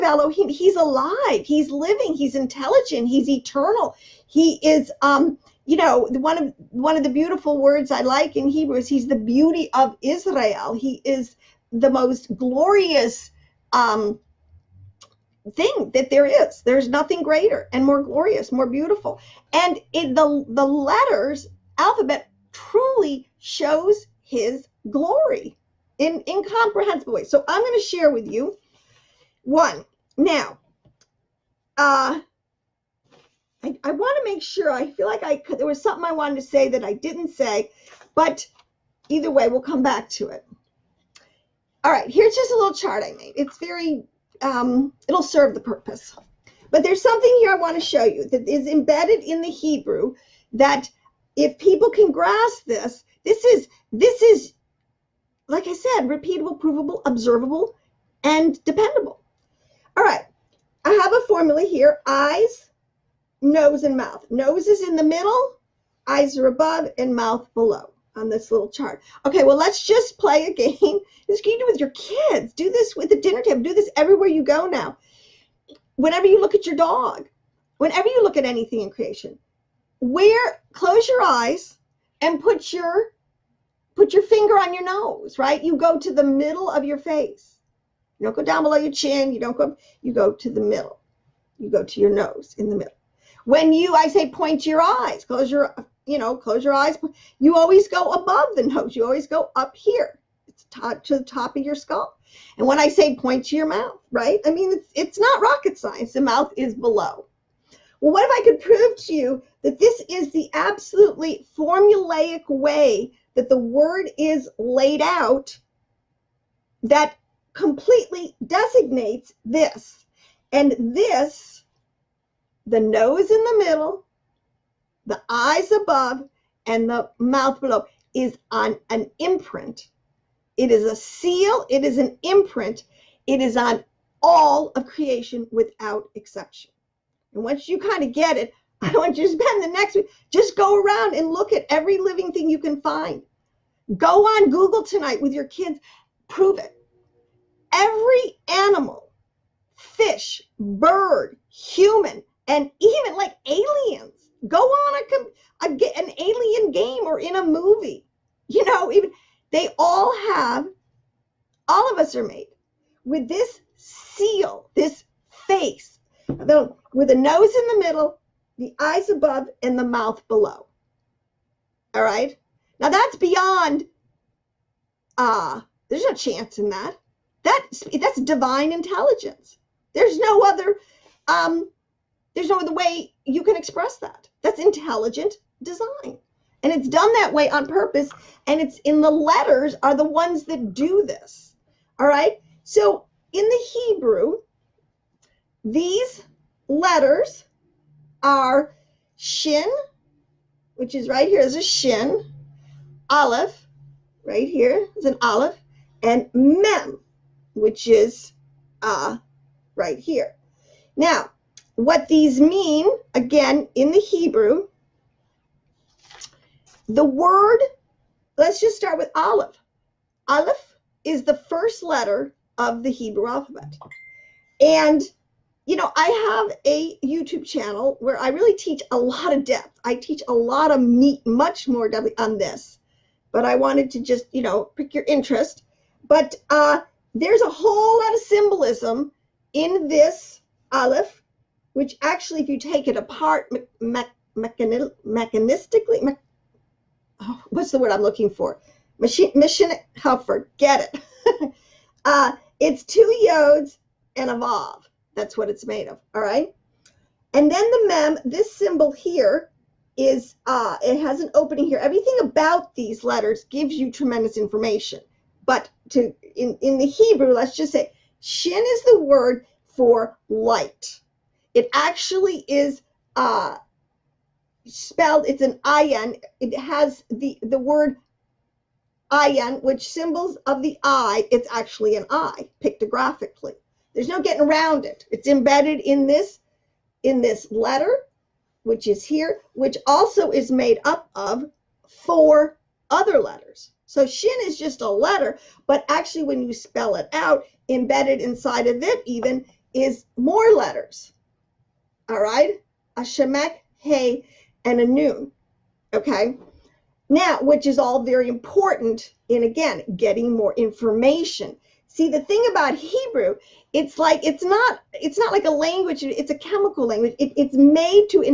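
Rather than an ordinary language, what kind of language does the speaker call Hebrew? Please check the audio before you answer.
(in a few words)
A chemical language.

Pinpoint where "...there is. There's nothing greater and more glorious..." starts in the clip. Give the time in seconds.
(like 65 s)
16 s.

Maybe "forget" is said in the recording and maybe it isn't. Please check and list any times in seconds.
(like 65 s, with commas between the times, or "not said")
250 s.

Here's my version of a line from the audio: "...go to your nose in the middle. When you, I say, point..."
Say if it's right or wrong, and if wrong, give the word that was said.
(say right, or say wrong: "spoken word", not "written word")
right.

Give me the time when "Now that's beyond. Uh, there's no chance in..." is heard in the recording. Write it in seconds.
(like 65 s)
172 s.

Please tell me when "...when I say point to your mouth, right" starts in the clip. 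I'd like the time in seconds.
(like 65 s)
102 s.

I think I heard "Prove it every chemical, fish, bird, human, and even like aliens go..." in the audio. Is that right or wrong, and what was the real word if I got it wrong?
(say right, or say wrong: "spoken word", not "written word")
wrong: "animal", not "chemical".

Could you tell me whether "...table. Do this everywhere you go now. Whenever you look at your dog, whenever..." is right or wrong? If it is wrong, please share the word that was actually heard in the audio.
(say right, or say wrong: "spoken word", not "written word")
right.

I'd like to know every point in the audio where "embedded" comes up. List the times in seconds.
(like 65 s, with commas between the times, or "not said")
48 s, 285 s, 297 s.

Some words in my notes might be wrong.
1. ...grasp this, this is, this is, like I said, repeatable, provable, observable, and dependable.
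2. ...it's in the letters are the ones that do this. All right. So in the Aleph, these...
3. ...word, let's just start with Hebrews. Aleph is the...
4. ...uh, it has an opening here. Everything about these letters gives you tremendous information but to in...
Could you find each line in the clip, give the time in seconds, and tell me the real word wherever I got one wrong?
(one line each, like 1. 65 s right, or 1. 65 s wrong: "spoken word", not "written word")
1. 52 s right
2. 188 s wrong: "Hebrew", not "Aleph"
3. 217 s wrong: "Aleph", not "Hebrews"
4. 260 s right.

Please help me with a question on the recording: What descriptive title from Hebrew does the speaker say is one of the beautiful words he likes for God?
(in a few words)
The beauty of Israel.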